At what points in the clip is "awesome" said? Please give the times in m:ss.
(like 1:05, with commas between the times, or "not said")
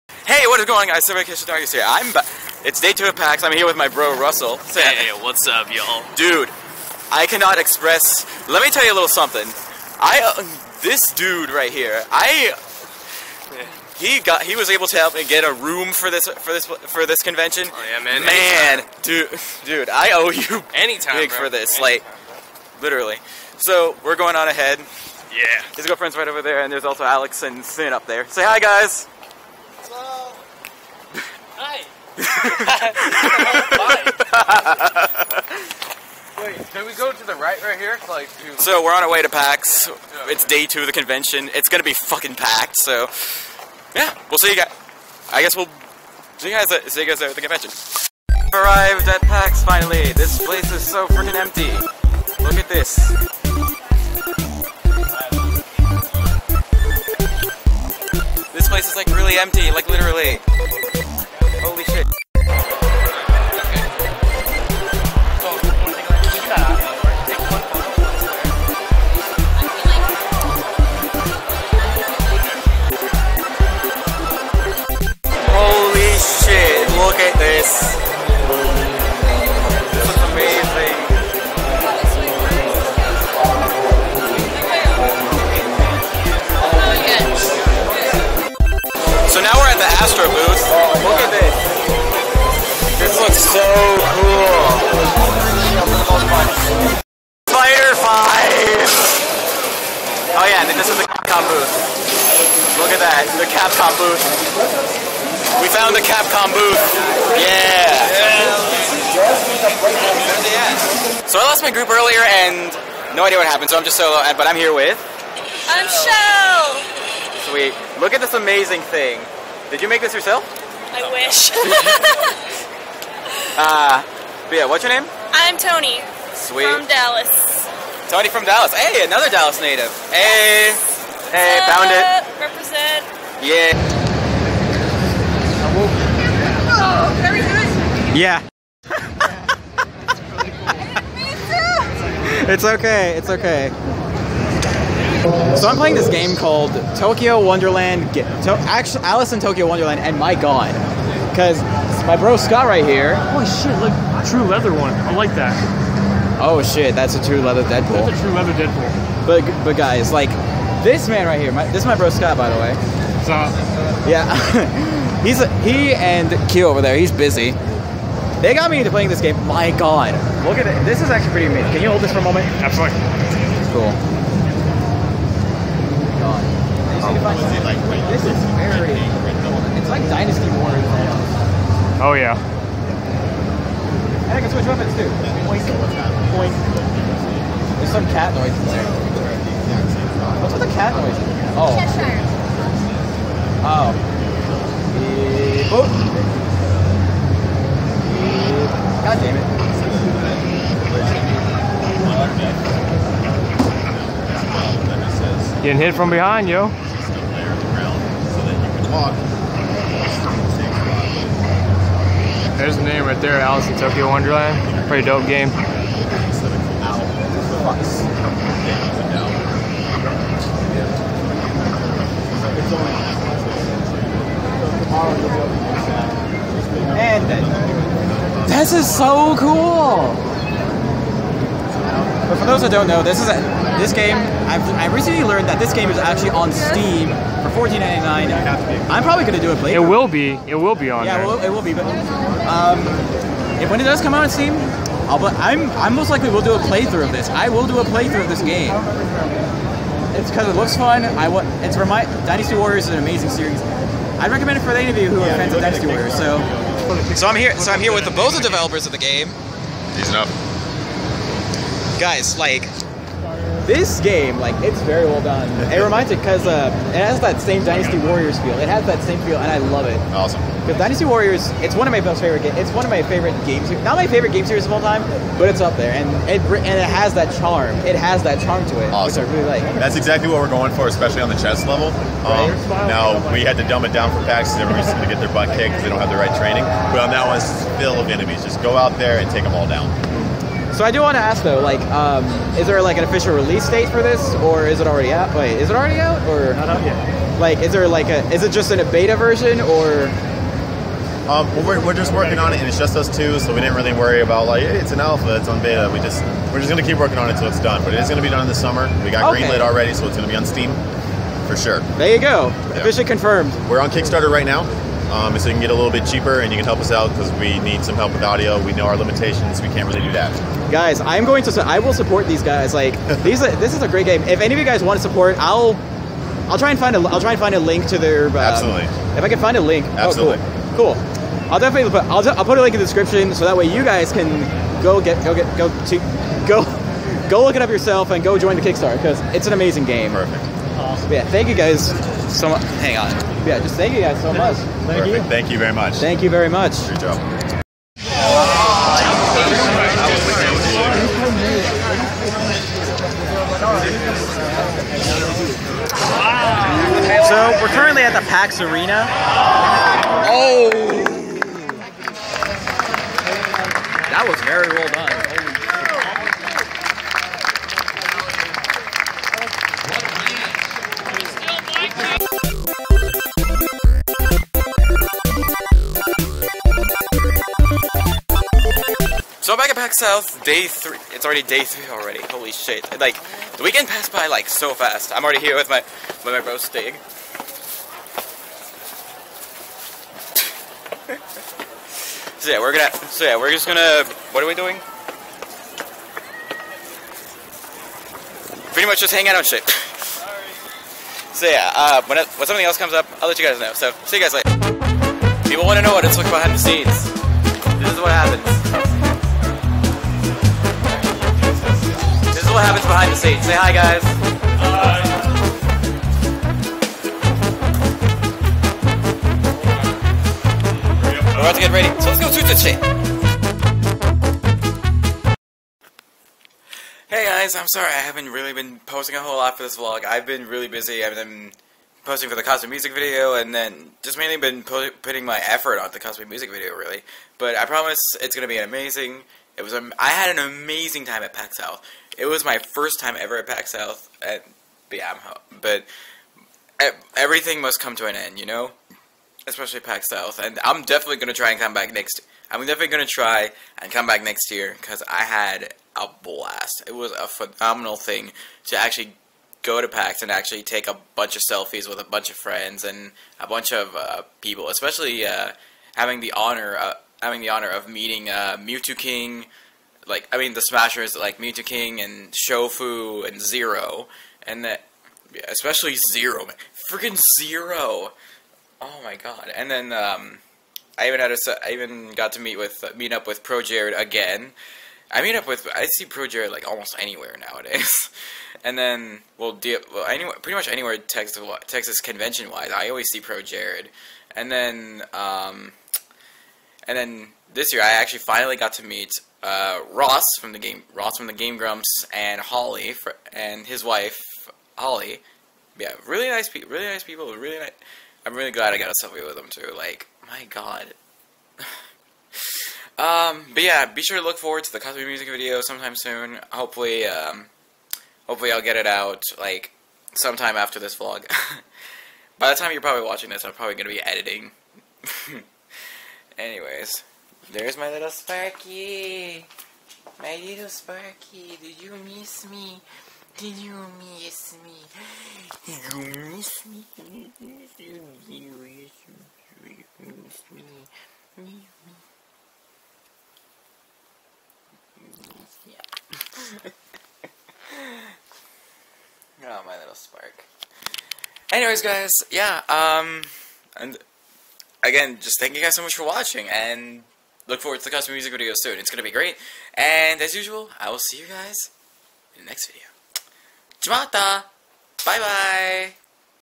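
4:30, 4:38, 5:40.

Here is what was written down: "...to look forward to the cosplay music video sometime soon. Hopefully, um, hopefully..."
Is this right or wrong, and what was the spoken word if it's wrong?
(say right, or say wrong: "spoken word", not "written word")
right.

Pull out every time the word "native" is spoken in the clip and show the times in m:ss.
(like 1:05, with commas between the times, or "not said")
2:09.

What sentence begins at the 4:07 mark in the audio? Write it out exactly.
I will do a playthrough of this game.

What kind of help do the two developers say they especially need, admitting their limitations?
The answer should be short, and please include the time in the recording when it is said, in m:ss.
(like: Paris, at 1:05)
Audio, at 5:18.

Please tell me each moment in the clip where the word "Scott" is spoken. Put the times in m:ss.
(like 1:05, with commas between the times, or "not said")
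2:32, 2:42.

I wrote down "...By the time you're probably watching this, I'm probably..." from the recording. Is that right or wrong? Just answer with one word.
right.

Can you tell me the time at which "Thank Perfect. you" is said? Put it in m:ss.
5:44.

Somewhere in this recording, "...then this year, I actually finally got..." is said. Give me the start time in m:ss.
8:16.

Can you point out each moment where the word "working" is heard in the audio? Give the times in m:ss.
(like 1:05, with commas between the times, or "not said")
5:02, 5:06.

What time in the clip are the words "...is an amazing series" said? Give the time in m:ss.
4:12.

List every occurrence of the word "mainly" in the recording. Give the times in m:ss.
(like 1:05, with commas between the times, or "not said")
7:14.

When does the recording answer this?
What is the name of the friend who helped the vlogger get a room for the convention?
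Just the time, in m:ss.
0:04.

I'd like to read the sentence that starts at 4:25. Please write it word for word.
It reminds me because uh, it has that same Dynasty Warriors feel.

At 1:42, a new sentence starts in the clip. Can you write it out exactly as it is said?
Look at that, the Capcom booth.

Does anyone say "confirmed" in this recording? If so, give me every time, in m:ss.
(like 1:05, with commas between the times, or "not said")
5:13.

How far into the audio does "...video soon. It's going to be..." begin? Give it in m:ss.
9:18.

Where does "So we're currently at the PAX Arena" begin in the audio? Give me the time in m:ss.
5:57.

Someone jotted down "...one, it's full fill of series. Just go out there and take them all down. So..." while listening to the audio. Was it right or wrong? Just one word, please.
wrong.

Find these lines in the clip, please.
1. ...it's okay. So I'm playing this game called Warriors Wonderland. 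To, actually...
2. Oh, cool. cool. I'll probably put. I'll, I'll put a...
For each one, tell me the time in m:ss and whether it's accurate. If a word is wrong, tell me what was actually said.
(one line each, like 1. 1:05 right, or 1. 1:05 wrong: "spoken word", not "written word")
1. 2:23 wrong: "Tokyo", not "Warriors"
2. 5:30 wrong: "definitely", not "probably".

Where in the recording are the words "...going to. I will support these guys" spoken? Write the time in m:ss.
5:21.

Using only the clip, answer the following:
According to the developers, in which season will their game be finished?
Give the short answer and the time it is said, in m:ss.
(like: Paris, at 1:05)
Summer, at 5:08.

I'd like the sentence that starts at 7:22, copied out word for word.
It was my first time ever at PAX South, at but yeah, I'm home.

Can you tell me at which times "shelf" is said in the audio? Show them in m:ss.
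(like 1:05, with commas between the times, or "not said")
not said.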